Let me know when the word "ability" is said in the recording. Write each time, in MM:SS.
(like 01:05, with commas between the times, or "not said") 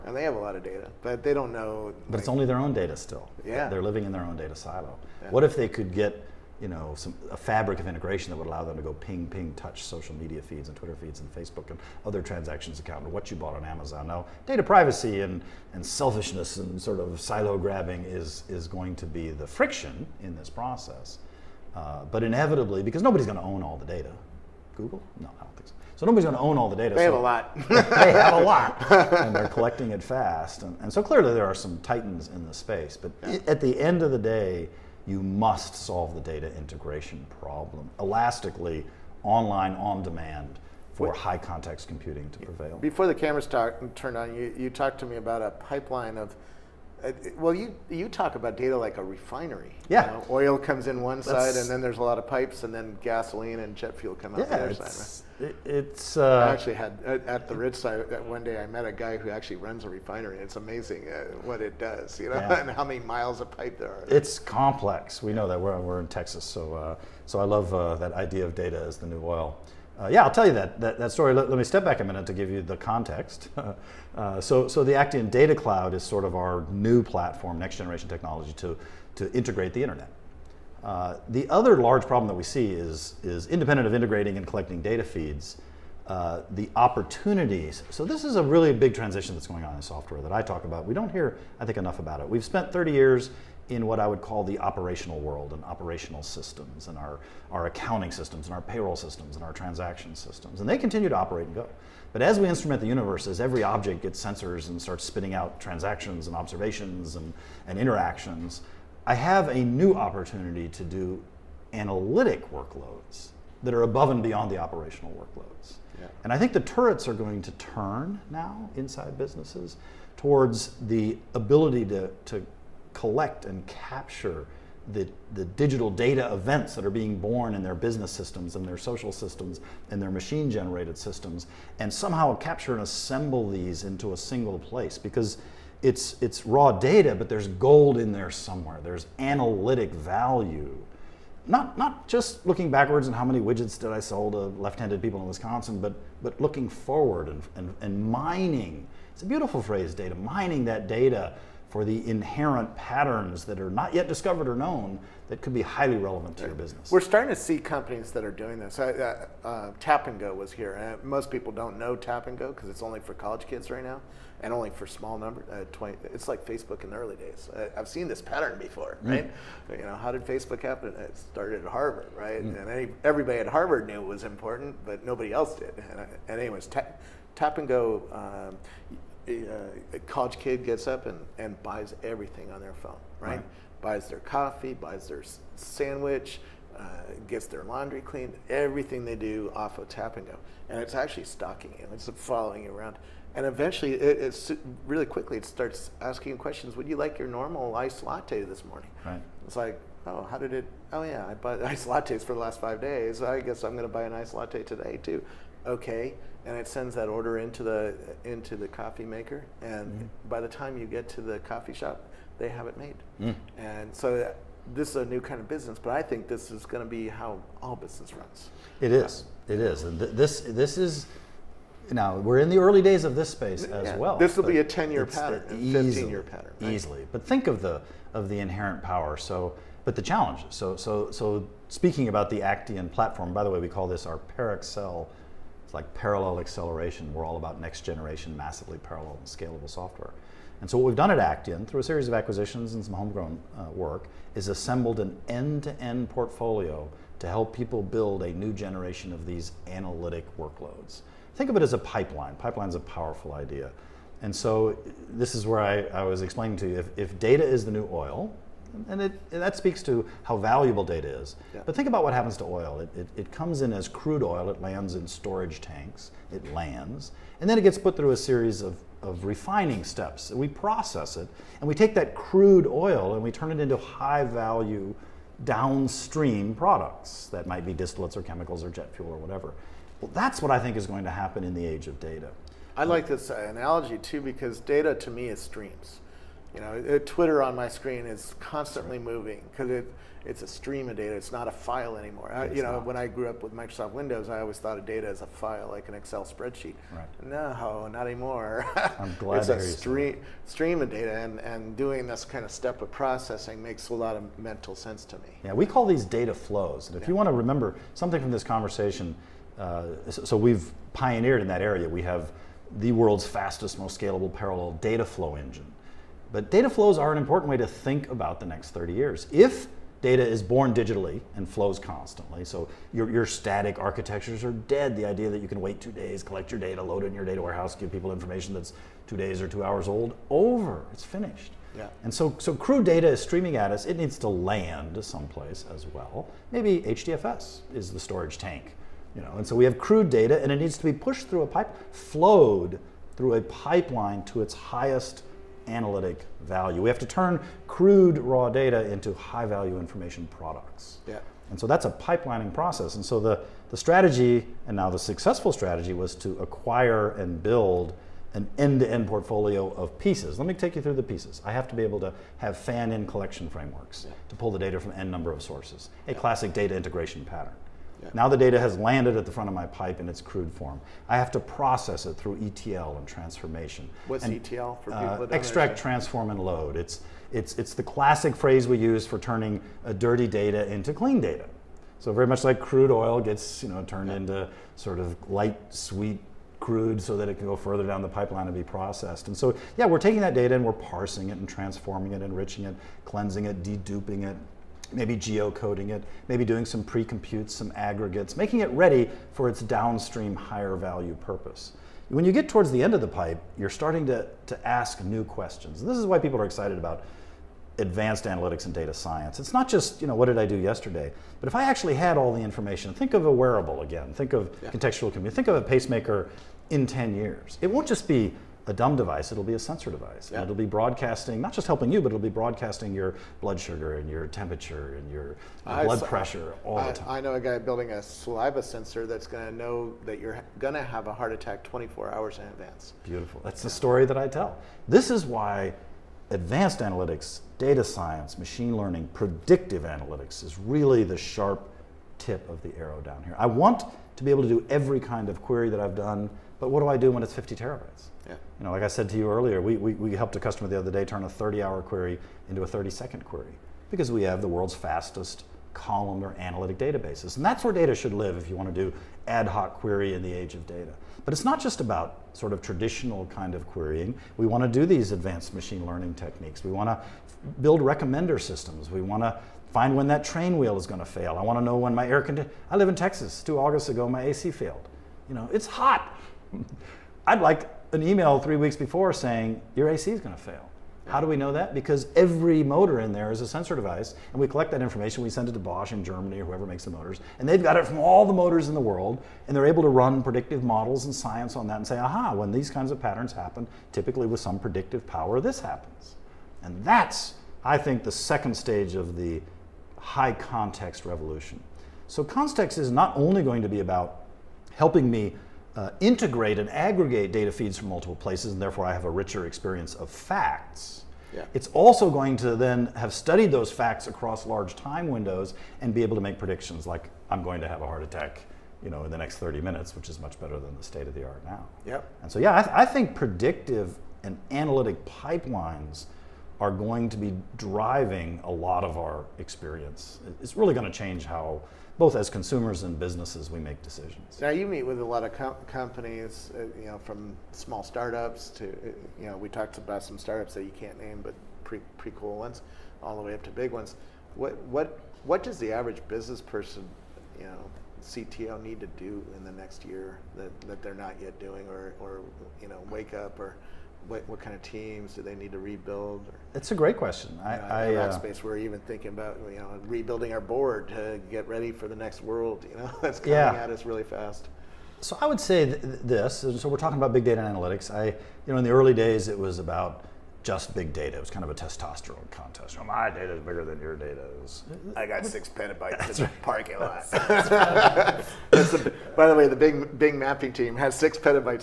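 02:01.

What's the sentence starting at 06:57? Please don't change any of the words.
It won't just be a dumb device, it'll be a sensor device.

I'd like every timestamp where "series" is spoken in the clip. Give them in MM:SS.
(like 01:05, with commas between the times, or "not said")
04:01, 04:28.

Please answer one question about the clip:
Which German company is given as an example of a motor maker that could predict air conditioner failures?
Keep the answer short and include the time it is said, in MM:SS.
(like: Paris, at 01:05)
Bosch, at 08:05.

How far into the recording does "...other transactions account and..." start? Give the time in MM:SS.
00:12.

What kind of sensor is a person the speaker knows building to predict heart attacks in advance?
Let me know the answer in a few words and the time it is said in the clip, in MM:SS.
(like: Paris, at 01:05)
saliva sensor, at 07:08.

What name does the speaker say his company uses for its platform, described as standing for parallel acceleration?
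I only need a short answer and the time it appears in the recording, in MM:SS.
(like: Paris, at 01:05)
ParAccel, at 03:54.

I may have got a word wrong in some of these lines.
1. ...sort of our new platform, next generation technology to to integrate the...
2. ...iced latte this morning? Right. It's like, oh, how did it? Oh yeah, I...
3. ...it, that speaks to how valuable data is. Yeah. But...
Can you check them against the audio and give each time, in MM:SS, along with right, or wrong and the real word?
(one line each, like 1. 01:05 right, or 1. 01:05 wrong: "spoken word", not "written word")
1. 01:16 right
2. 03:17 right
3. 04:19 right.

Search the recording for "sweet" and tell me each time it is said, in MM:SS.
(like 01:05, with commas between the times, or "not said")
06:25.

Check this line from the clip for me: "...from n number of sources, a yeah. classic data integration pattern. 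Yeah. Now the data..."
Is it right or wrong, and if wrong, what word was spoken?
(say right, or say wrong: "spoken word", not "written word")
right.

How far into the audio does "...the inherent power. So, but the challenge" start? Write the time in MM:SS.
03:48.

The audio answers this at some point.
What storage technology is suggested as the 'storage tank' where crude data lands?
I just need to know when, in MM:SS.
05:36.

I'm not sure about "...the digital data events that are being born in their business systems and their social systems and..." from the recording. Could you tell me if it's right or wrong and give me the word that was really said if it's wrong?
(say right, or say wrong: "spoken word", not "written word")
right.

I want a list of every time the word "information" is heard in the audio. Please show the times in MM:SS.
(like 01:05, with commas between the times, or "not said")
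05:28, 05:49, 06:52, 08:04.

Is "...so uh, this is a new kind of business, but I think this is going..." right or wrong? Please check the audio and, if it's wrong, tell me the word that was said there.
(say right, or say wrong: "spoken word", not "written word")
right.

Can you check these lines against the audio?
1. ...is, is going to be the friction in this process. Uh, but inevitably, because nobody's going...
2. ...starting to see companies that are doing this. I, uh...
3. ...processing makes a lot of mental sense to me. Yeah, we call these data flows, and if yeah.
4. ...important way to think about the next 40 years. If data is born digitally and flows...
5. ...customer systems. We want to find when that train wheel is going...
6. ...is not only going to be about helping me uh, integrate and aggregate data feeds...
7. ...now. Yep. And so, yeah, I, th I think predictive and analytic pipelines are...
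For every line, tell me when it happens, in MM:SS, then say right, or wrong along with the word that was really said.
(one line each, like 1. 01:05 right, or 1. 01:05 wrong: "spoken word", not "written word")
1. 00:18 right
2. 02:37 right
3. 05:02 right
4. 05:17 wrong: "30", not "40"
5. 07:47 wrong: "recommender", not "customer"
6. 08:22 right
7. 08:41 right.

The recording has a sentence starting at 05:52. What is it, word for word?
And so the, the strategy, and now the successful strategy, was to acquire and build an end-to-end portfolio of pieces.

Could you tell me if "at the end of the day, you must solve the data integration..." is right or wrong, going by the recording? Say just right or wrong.
right.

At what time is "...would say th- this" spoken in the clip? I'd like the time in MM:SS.
09:25.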